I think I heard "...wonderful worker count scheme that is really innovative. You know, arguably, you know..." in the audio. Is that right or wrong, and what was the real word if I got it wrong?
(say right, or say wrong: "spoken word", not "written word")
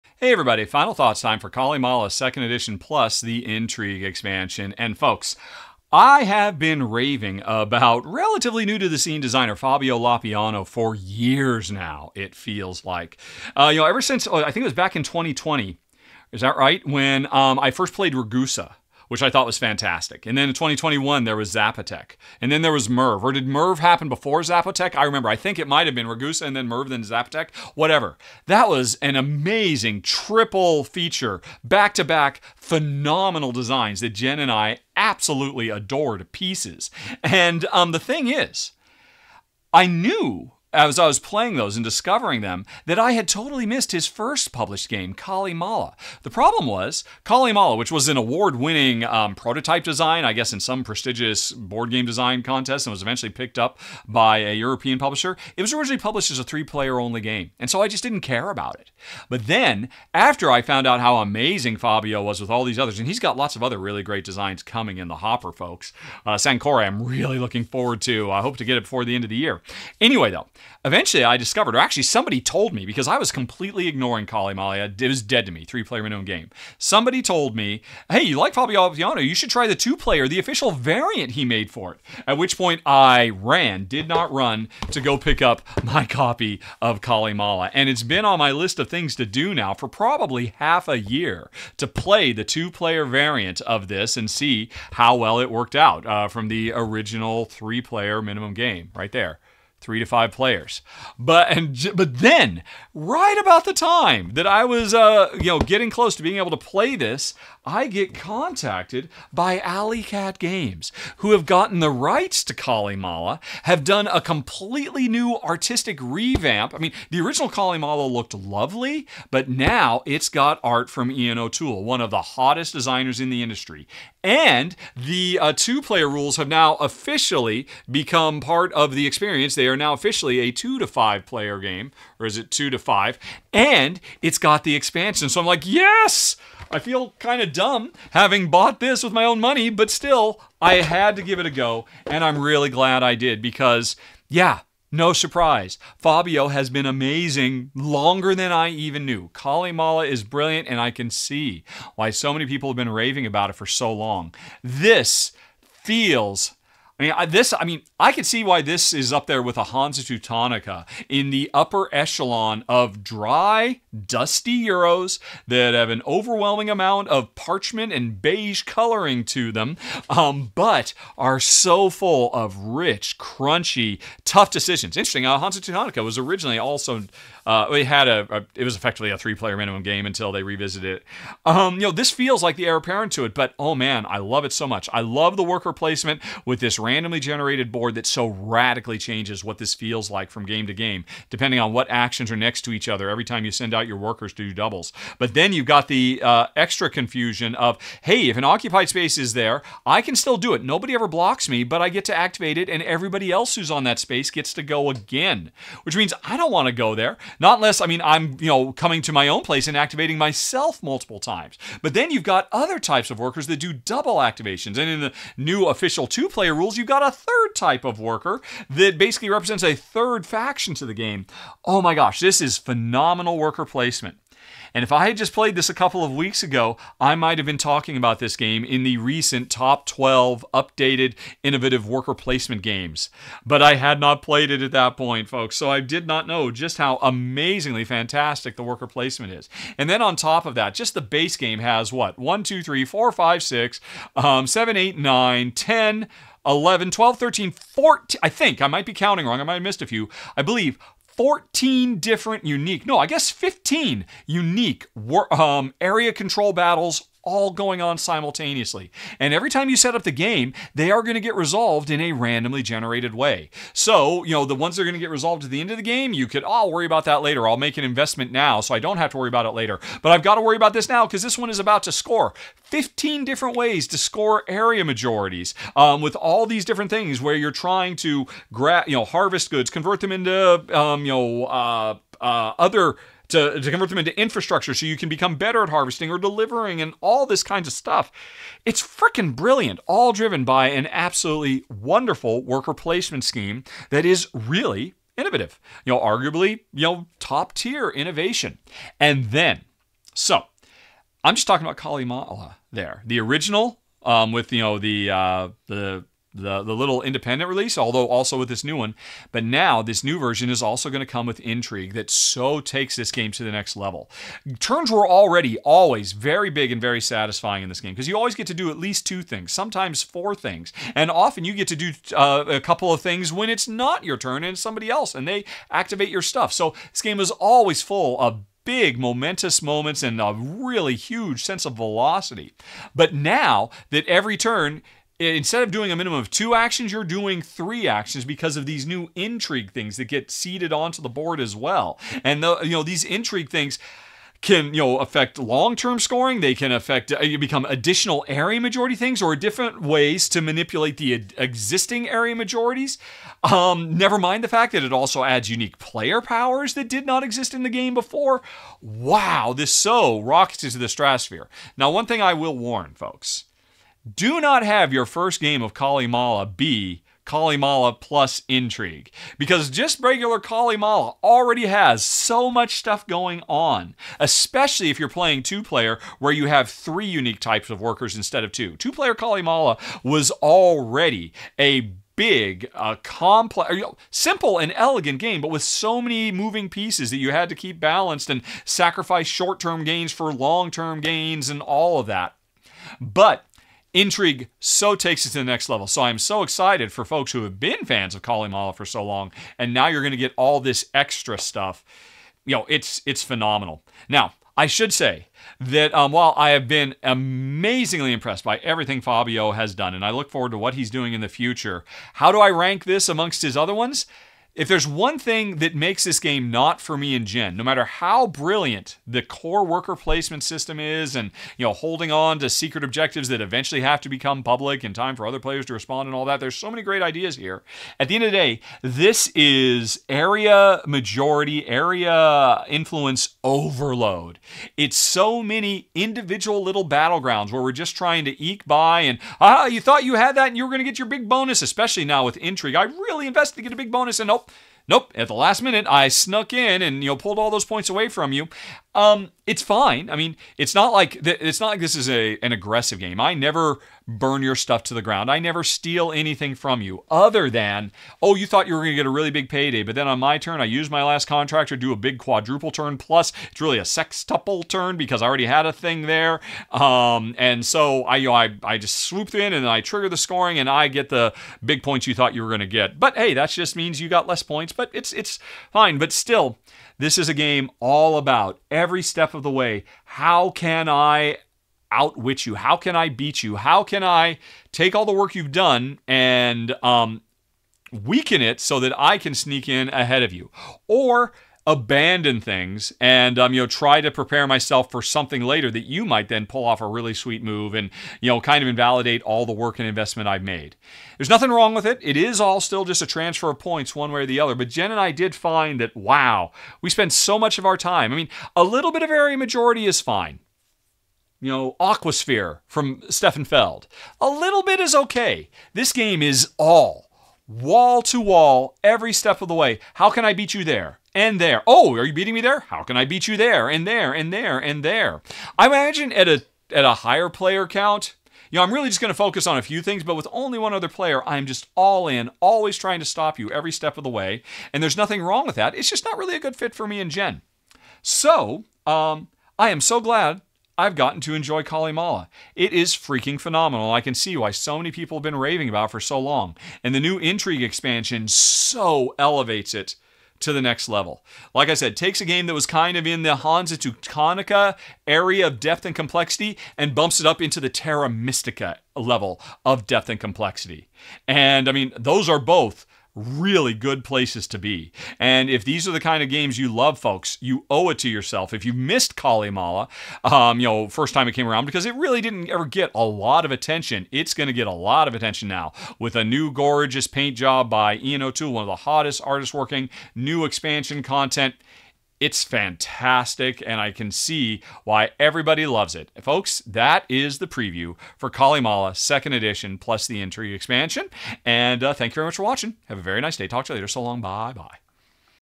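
wrong: "placement", not "count".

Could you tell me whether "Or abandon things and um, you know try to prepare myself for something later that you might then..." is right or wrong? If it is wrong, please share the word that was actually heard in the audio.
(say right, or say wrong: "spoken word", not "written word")
right.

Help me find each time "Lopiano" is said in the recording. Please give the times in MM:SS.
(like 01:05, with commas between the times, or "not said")
00:09.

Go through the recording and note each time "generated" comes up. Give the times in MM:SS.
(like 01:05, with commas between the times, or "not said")
03:07, 04:22.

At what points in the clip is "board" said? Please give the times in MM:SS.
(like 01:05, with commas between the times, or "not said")
00:51, 03:07, 05:41.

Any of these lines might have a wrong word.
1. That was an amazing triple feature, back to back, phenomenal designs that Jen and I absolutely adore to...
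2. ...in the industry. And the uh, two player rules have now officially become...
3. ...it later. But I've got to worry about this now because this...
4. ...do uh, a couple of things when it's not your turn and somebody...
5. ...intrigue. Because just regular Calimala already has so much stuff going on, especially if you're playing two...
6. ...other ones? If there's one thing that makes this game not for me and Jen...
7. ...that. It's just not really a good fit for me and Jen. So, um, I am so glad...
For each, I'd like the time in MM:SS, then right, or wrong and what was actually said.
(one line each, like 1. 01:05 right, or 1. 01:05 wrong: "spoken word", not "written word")
1. 00:28 right
2. 02:03 right
3. 04:29 right
4. 05:21 right
5. 06:08 right
6. 06:53 right
7. 08:55 right.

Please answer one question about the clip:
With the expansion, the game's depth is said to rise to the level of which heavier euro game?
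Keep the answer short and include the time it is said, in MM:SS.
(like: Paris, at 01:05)
Terra Mystica, at 09:17.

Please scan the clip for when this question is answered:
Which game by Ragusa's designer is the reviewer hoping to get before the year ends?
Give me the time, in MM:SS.
01:06.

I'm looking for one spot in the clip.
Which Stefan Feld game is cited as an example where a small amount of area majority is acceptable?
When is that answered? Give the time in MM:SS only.
08:31.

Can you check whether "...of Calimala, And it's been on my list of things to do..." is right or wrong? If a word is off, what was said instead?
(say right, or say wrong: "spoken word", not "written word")
right.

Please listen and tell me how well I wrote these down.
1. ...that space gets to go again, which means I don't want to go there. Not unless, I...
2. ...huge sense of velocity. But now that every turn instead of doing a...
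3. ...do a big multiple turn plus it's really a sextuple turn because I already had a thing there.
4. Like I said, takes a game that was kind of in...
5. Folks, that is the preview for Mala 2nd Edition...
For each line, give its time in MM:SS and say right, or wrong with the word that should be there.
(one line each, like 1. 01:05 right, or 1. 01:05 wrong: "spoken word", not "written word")
1. 03:23 right
2. 05:30 right
3. 07:41 wrong: "quadruple", not "multiple"
4. 09:11 right
5. 09:46 wrong: "Calimala", not "Mala".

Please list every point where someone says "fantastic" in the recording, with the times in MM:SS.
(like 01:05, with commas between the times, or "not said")
00:19, 03:57, 09:42.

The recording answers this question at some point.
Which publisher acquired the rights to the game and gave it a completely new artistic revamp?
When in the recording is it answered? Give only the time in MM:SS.
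01:49.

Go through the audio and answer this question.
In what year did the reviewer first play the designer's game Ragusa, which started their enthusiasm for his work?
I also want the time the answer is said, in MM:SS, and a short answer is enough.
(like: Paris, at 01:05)
2020, at 00:15.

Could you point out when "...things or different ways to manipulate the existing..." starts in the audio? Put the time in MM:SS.
05:48.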